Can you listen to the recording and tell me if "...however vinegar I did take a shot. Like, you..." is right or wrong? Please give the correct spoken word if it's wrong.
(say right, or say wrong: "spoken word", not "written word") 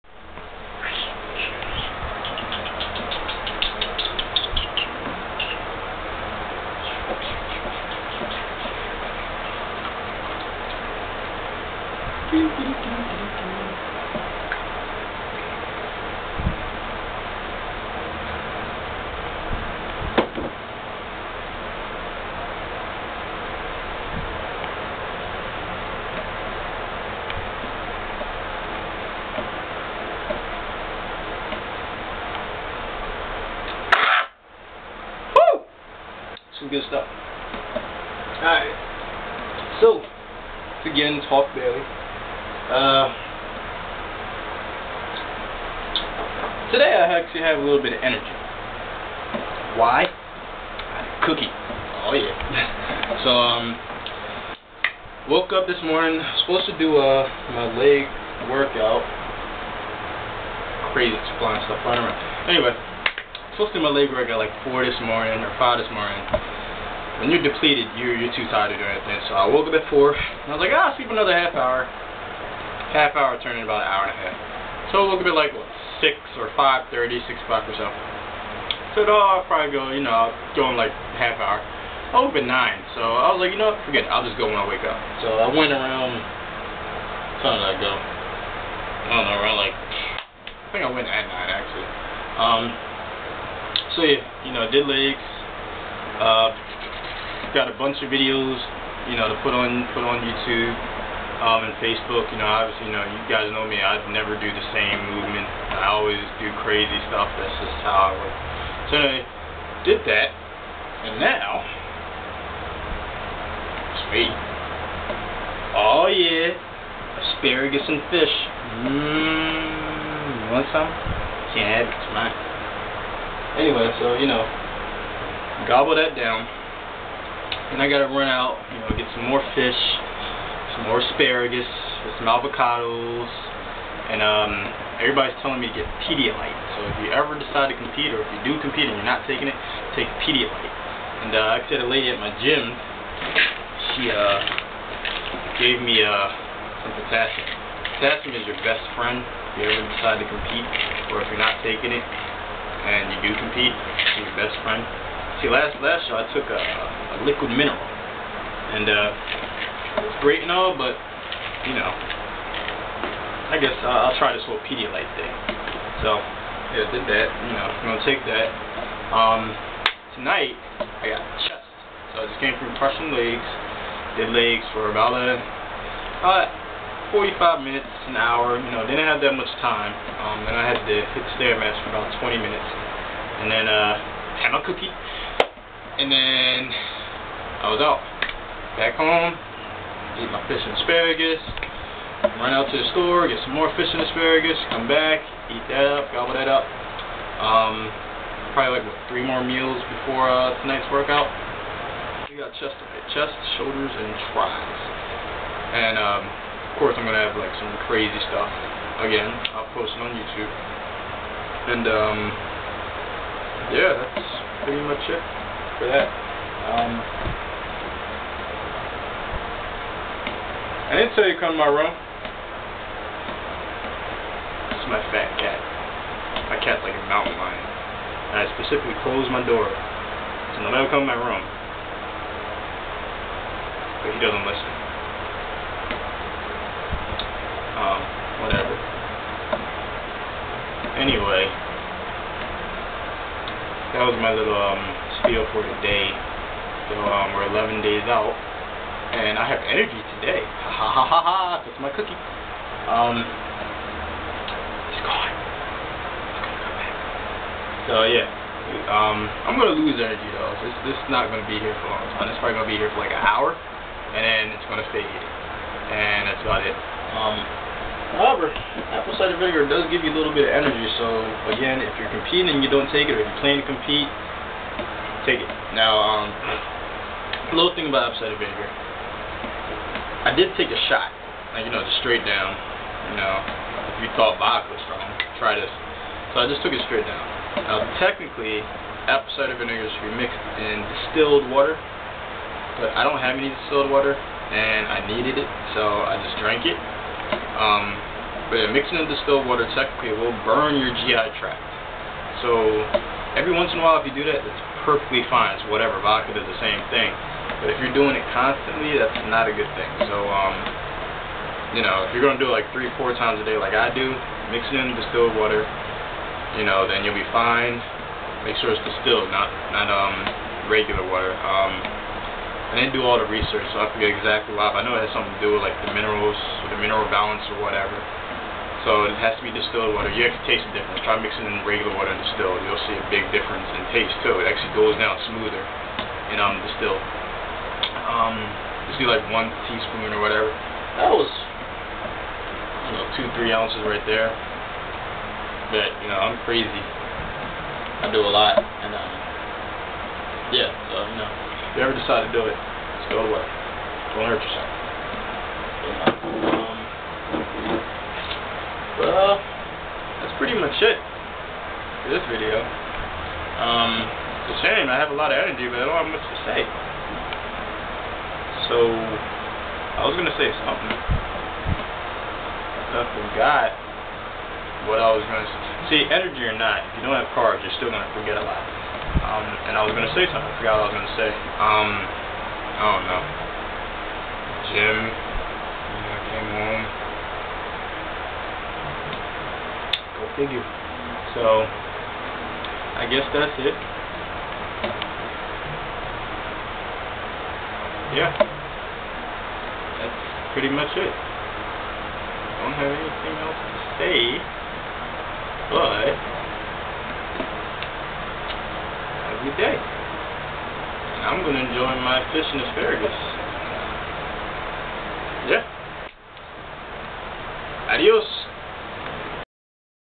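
wrong: "cider", not "however".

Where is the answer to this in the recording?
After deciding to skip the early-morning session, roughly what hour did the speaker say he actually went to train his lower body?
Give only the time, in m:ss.
1:30.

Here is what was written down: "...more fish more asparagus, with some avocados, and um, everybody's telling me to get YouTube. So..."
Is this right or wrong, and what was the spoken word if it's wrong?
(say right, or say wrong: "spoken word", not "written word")
wrong: "Pedialyte", not "YouTube".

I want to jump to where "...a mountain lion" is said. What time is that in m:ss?
3:46.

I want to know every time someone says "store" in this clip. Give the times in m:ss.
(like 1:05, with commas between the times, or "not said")
3:12.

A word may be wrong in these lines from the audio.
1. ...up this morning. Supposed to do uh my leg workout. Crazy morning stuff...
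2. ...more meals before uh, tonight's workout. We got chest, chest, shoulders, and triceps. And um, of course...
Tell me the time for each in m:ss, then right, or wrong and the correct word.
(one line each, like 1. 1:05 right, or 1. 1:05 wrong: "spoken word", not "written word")
1. 0:55 wrong: "flying", not "morning"
2. 3:19 right.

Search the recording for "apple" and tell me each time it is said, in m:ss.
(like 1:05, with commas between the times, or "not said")
4:28, 4:38, 4:49.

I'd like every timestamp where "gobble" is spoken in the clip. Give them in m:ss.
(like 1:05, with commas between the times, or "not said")
2:05, 3:16.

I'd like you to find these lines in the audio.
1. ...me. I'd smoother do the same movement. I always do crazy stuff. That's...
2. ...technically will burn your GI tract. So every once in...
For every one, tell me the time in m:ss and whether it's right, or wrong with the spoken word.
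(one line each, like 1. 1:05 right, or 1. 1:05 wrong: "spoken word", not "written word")
1. 1:43 wrong: "never", not "smoother"
2. 4:59 right.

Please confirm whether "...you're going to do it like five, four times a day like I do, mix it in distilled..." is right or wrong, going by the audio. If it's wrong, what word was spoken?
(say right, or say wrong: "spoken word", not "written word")
wrong: "three", not "five".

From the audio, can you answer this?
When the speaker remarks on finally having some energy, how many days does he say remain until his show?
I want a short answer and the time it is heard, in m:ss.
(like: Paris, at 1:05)
11 days, at 4:07.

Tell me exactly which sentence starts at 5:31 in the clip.
Try mixing in regular water and distilled.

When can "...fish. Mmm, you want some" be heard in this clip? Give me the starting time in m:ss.
1:58.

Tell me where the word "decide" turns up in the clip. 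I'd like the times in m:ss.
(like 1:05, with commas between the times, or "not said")
2:17, 2:30, 5:51.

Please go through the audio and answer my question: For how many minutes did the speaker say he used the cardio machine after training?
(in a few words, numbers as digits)
20 minutes.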